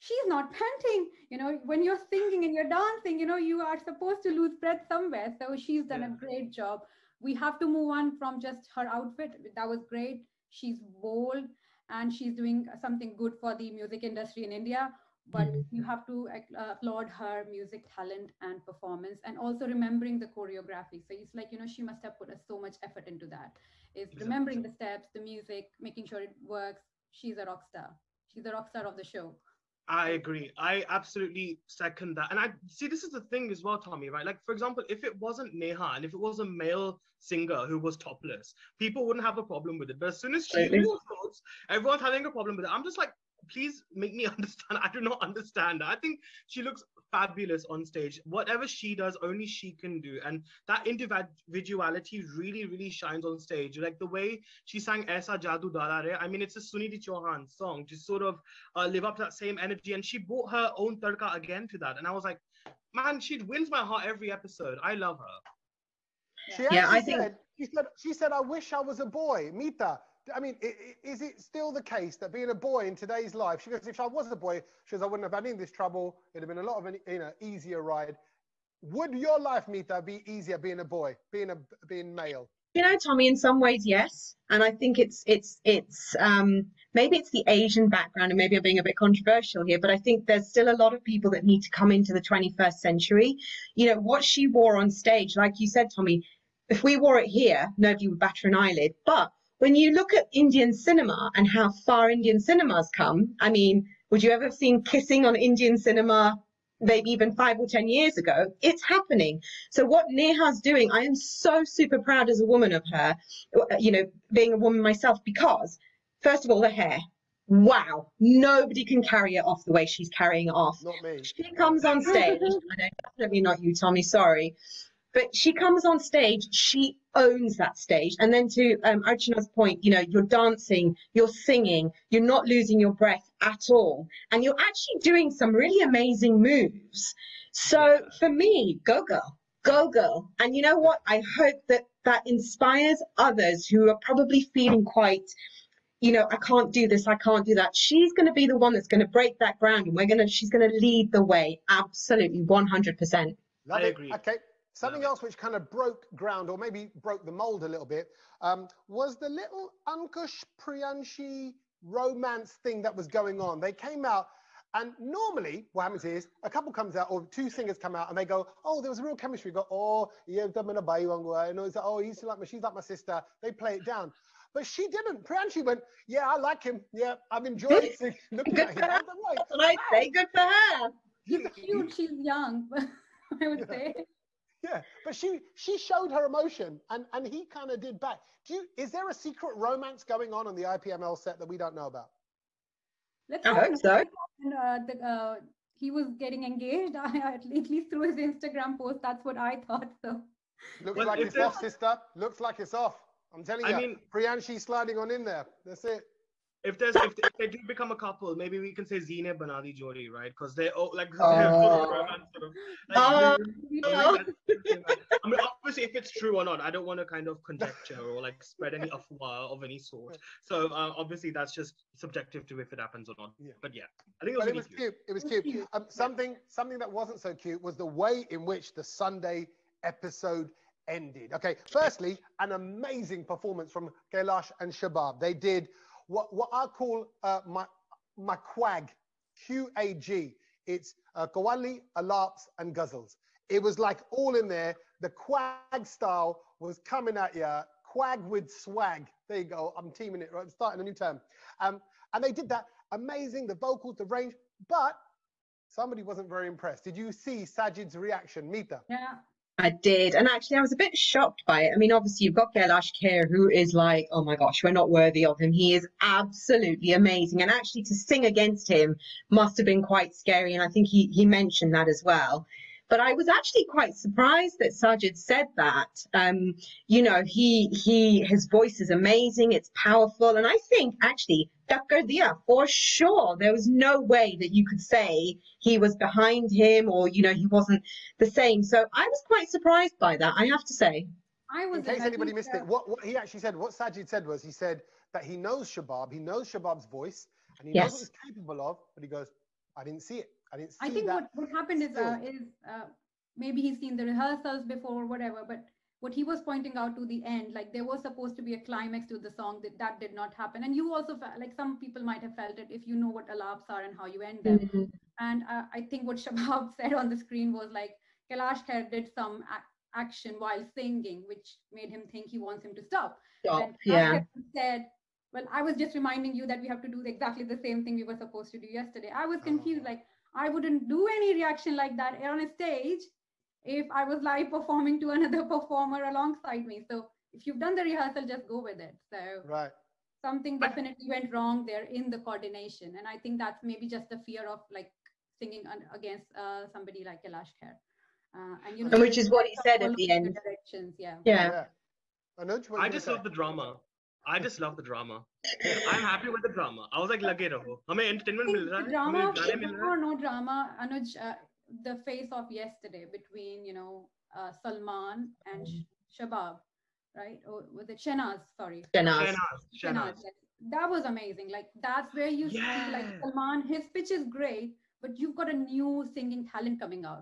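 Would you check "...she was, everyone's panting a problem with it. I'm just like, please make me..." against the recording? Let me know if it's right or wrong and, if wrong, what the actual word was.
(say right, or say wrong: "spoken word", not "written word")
wrong: "having", not "panting".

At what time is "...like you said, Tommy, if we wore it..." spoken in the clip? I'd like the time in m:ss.
1:35.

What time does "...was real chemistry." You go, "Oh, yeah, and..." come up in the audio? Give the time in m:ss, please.
2:48.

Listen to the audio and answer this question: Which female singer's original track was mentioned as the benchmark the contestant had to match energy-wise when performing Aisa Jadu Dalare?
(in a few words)
Sunidhi Chauhan.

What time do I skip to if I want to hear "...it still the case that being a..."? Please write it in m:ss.
1:11.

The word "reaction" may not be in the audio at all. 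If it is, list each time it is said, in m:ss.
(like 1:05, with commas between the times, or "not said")
4:17, 5:31.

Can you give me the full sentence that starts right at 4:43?
There was no way that you could say he was behind him or you know he wasn't the same.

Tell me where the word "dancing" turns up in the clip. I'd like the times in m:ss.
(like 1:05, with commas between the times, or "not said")
0:02, 2:10.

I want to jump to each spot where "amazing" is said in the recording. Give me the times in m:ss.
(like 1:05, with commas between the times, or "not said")
2:15, 3:52, 4:12, 4:26, 4:38, 6:11.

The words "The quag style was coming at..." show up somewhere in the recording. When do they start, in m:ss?
4:05.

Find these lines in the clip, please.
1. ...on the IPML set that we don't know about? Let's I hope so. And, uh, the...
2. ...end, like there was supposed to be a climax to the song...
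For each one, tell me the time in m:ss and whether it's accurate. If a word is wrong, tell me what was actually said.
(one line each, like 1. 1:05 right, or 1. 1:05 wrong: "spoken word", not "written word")
1. 3:10 right
2. 5:07 right.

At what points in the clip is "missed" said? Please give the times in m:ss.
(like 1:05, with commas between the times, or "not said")
4:52.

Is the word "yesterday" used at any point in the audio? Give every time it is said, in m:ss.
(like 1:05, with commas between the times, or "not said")
5:28, 6:02.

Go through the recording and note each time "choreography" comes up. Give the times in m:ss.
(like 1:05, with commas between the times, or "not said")
0:20.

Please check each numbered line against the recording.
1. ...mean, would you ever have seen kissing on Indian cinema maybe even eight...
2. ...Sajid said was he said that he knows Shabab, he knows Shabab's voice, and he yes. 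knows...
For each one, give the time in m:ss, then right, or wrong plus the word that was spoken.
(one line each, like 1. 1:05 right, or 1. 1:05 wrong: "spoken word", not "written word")
1. 1:43 wrong: "five", not "eight"
2. 4:53 right.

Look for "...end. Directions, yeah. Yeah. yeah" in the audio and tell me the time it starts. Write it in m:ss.
5:50.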